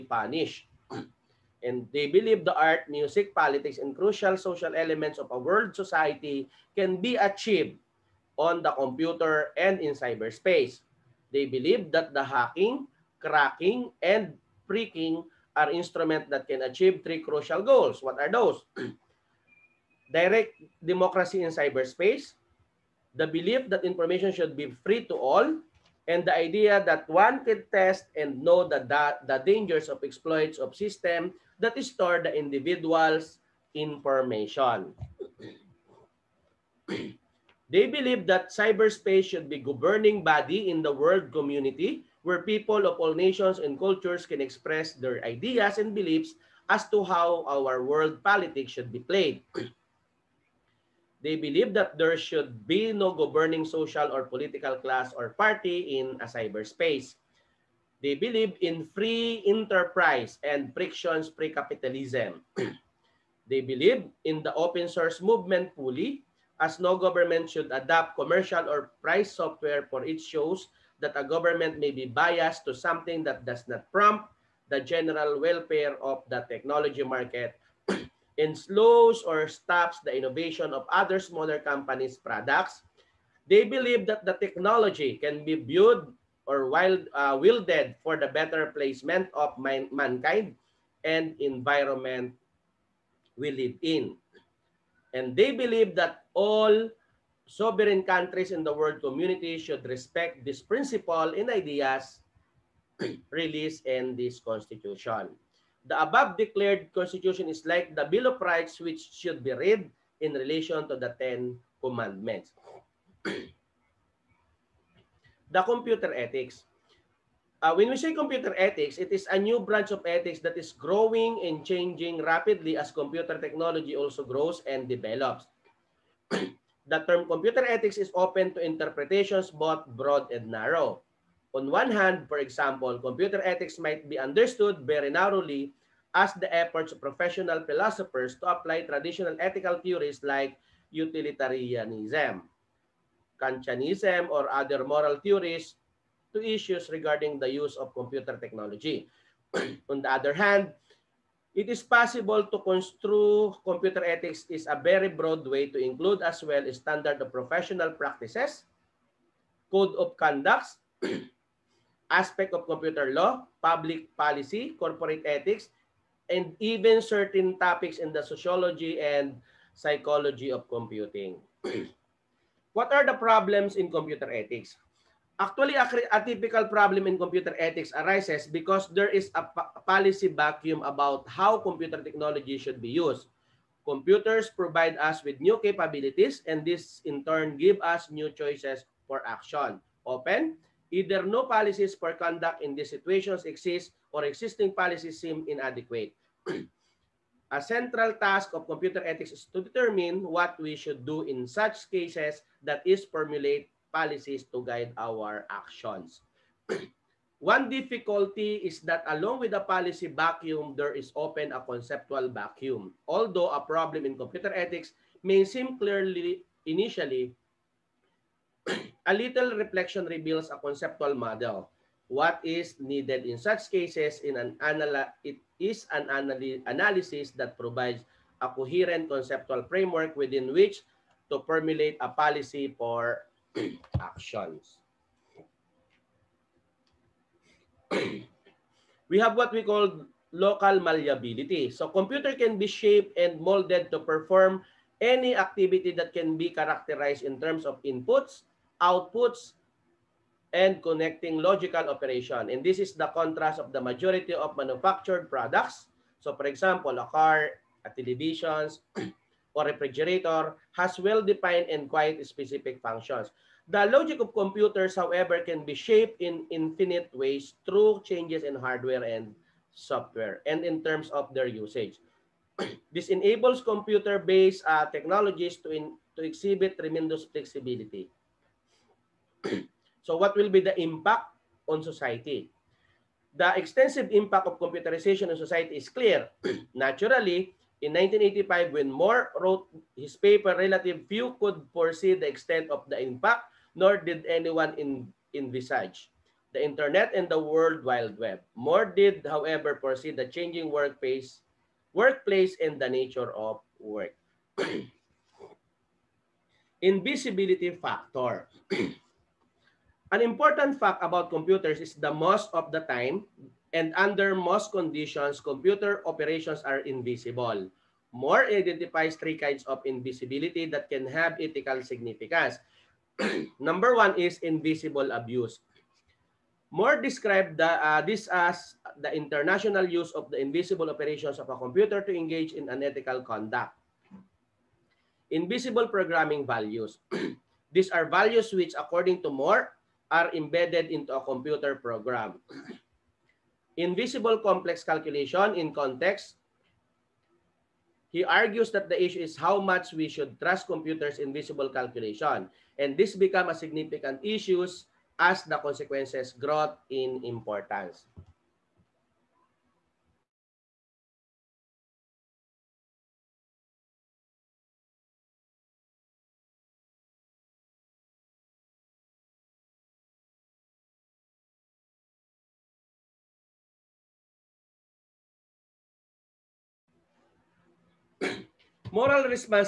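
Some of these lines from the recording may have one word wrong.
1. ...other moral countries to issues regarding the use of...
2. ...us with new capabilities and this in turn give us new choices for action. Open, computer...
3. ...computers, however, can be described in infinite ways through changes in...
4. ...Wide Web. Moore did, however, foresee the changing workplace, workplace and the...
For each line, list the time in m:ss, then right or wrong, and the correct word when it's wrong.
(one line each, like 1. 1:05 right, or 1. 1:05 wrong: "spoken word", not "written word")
1. 2:24 wrong: "theories", not "countries"
2. 3:04 wrong: "either", not "computer"
3. 4:24 wrong: "shaped", not "described"
4. 4:57 right.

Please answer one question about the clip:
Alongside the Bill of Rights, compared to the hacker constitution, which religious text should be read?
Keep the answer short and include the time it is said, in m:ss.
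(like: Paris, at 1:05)
The Ten Commandments, at 1:51.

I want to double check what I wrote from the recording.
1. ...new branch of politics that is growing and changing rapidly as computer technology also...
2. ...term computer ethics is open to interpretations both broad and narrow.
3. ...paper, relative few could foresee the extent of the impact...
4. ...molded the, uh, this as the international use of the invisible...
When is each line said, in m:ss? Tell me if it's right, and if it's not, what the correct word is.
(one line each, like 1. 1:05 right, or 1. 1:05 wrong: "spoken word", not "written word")
1. 1:59 wrong: "ethics", not "politics"
2. 2:07 right
3. 4:50 right
4. 5:27 wrong: "described", not "molded".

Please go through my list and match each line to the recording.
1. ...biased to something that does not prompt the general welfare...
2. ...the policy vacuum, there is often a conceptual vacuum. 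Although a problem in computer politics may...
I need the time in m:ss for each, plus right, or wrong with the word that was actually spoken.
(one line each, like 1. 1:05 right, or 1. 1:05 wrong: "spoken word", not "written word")
1. 1:12 right
2. 3:29 wrong: "ethics", not "politics".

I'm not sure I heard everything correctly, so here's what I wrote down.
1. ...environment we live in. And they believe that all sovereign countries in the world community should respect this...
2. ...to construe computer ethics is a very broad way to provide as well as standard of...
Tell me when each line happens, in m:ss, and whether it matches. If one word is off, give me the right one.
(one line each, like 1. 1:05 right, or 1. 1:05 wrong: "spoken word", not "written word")
1. 1:31 right
2. 2:32 wrong: "include", not "provide".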